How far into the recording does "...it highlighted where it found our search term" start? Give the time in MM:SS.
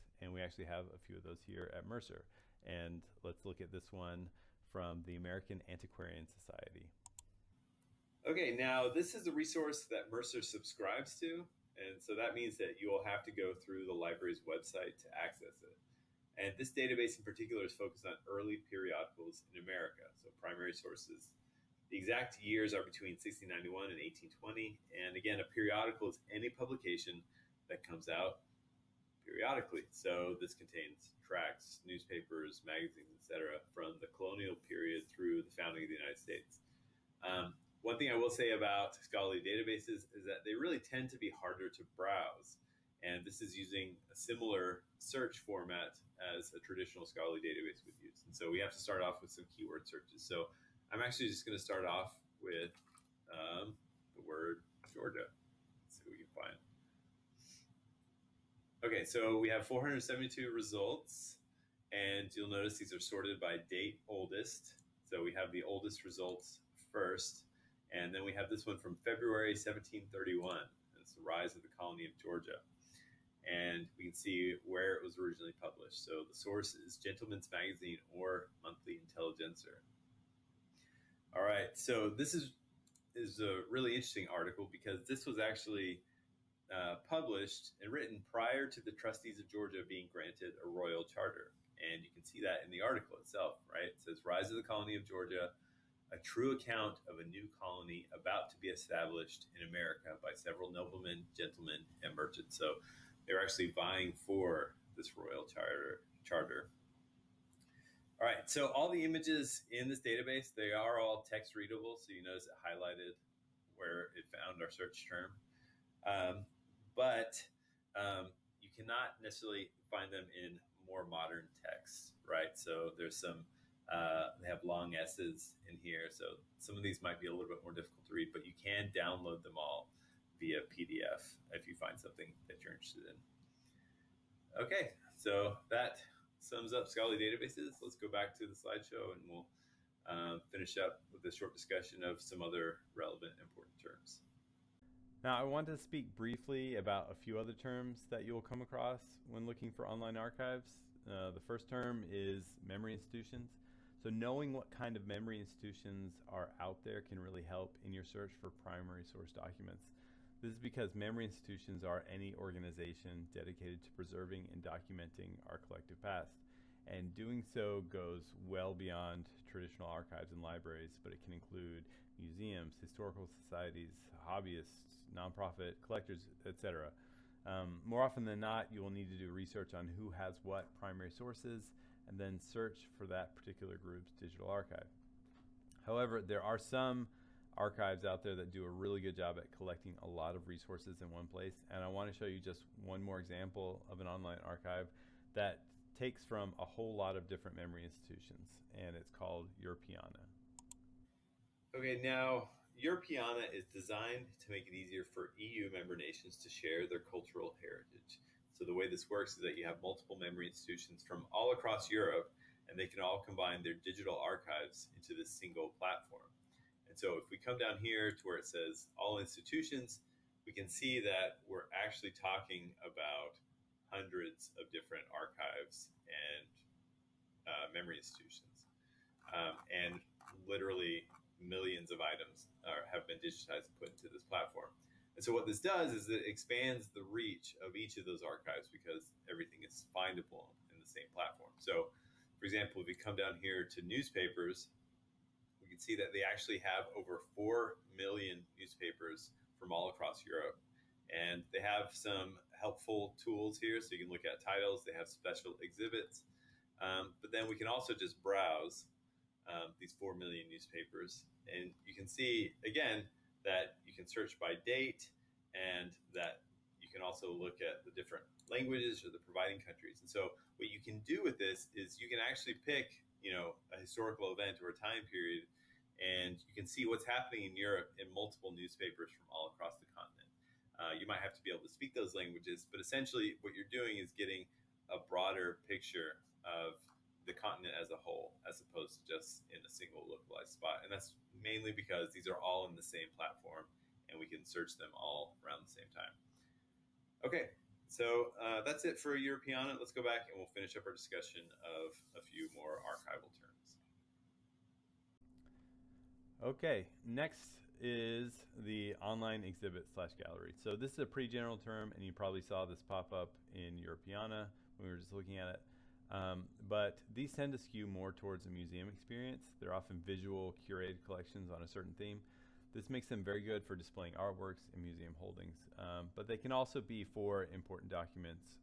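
01:52.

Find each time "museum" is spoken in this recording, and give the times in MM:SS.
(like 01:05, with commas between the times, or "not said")
02:52, 05:18, 05:24.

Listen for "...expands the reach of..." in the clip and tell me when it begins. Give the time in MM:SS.
03:56.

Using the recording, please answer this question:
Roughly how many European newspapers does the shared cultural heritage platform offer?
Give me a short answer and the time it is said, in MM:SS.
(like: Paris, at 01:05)
over 4 million, at 04:06.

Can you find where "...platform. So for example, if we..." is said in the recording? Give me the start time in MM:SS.
04:01.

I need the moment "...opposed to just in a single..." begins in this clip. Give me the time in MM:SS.
04:48.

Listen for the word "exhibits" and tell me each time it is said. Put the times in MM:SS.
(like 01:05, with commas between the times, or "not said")
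04:15, 05:09.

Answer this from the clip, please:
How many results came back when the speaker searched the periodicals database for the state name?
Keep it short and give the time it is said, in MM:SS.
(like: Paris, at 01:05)
472, at 00:59.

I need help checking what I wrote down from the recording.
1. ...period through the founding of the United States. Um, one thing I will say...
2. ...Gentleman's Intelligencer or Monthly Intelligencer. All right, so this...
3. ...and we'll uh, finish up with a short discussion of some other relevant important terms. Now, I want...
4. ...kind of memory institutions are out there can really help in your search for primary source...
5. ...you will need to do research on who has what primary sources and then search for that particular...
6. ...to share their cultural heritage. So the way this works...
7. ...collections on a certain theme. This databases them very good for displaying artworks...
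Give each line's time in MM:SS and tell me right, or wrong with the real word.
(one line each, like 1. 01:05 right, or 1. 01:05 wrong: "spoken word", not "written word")
1. 00:34 right
2. 01:16 wrong: "Magazine", not "Intelligencer"
3. 02:19 right
4. 02:34 right
5. 02:58 right
6. 03:26 right
7. 05:21 wrong: "makes", not "databases".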